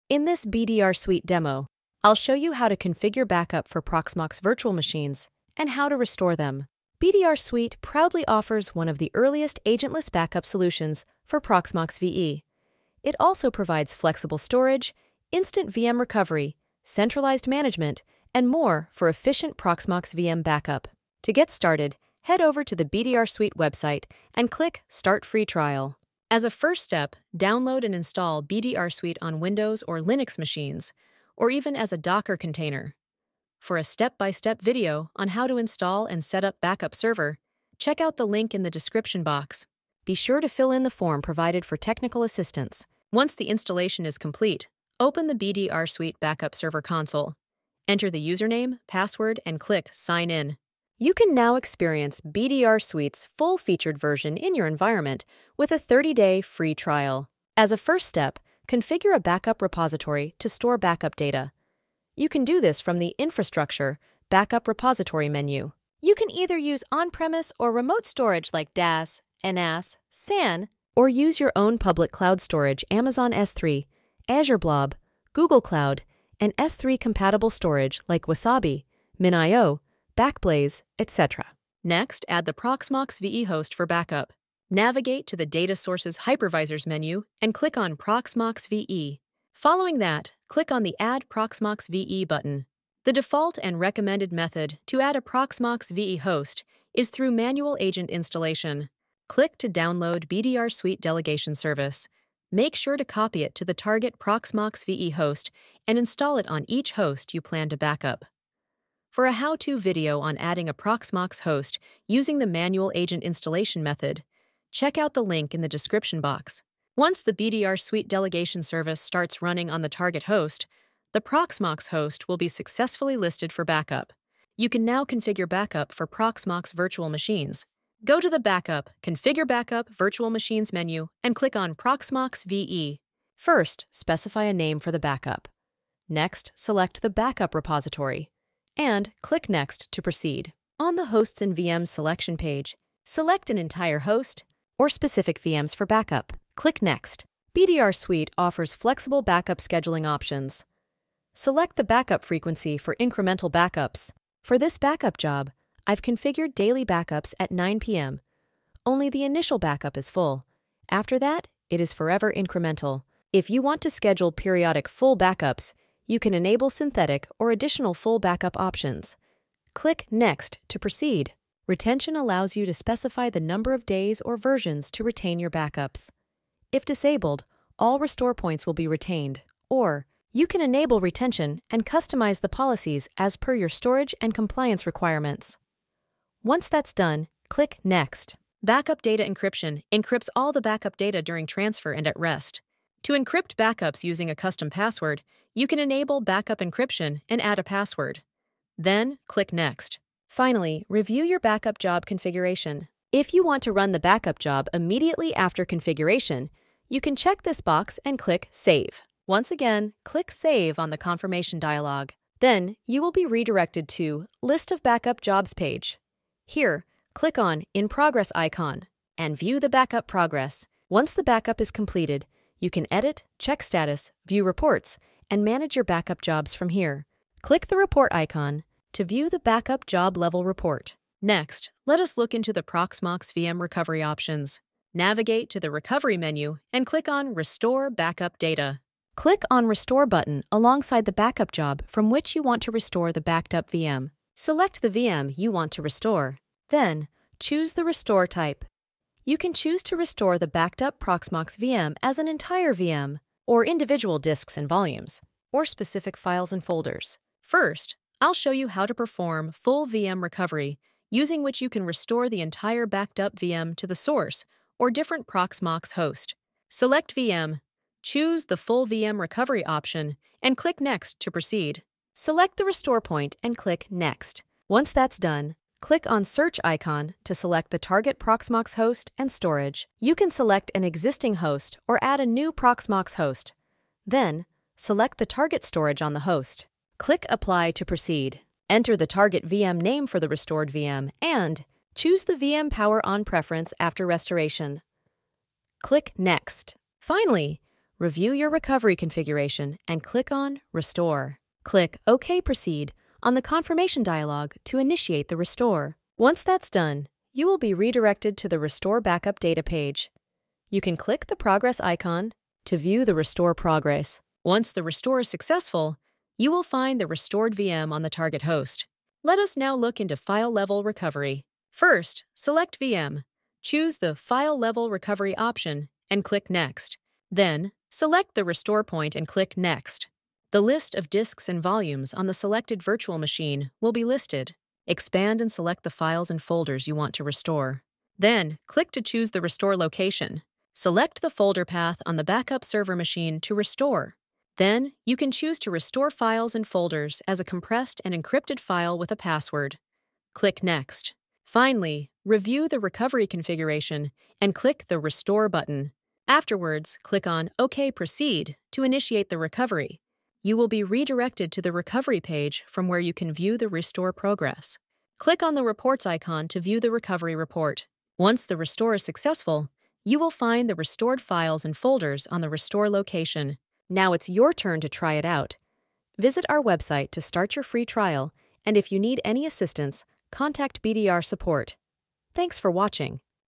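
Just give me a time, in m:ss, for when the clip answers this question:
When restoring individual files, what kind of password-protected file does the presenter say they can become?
5:47.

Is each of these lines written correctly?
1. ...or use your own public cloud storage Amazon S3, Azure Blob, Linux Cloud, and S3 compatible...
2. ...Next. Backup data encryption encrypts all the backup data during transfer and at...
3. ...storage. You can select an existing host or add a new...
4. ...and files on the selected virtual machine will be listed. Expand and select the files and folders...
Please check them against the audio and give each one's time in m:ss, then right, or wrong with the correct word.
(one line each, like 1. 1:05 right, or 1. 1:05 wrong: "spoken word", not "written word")
1. 1:10 wrong: "Google", not "Linux"
2. 3:07 right
3. 4:39 right
4. 5:31 wrong: "volumes", not "files".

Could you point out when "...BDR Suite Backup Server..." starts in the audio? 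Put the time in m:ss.
0:45.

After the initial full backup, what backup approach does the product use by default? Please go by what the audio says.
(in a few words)
forever incremental.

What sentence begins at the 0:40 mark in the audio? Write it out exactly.
Be sure to fill in the form provided for technical assistance.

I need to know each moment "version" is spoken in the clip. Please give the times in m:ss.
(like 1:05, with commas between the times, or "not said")
0:53, 2:54.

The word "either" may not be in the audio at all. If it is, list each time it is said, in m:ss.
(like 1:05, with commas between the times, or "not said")
1:06.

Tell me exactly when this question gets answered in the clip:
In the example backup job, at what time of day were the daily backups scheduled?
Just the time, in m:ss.
2:37.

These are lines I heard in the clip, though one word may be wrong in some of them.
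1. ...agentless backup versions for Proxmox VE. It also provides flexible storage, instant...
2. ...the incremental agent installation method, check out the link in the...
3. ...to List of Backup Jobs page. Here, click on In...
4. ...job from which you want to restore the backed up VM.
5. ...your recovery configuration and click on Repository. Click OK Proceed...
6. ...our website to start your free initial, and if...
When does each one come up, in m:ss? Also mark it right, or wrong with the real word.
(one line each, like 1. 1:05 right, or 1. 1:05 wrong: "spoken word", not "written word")
1. 0:09 wrong: "solutions", not "versions"
2. 1:52 wrong: "manual", not "incremental"
3. 3:33 right
4. 4:01 right
5. 4:58 wrong: "Restore", not "Repository"
6. 6:16 wrong: "trial", not "initial".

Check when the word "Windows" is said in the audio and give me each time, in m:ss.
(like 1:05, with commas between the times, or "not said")
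0:29.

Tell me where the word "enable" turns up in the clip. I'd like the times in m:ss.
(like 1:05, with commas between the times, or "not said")
2:46, 3:00, 3:15.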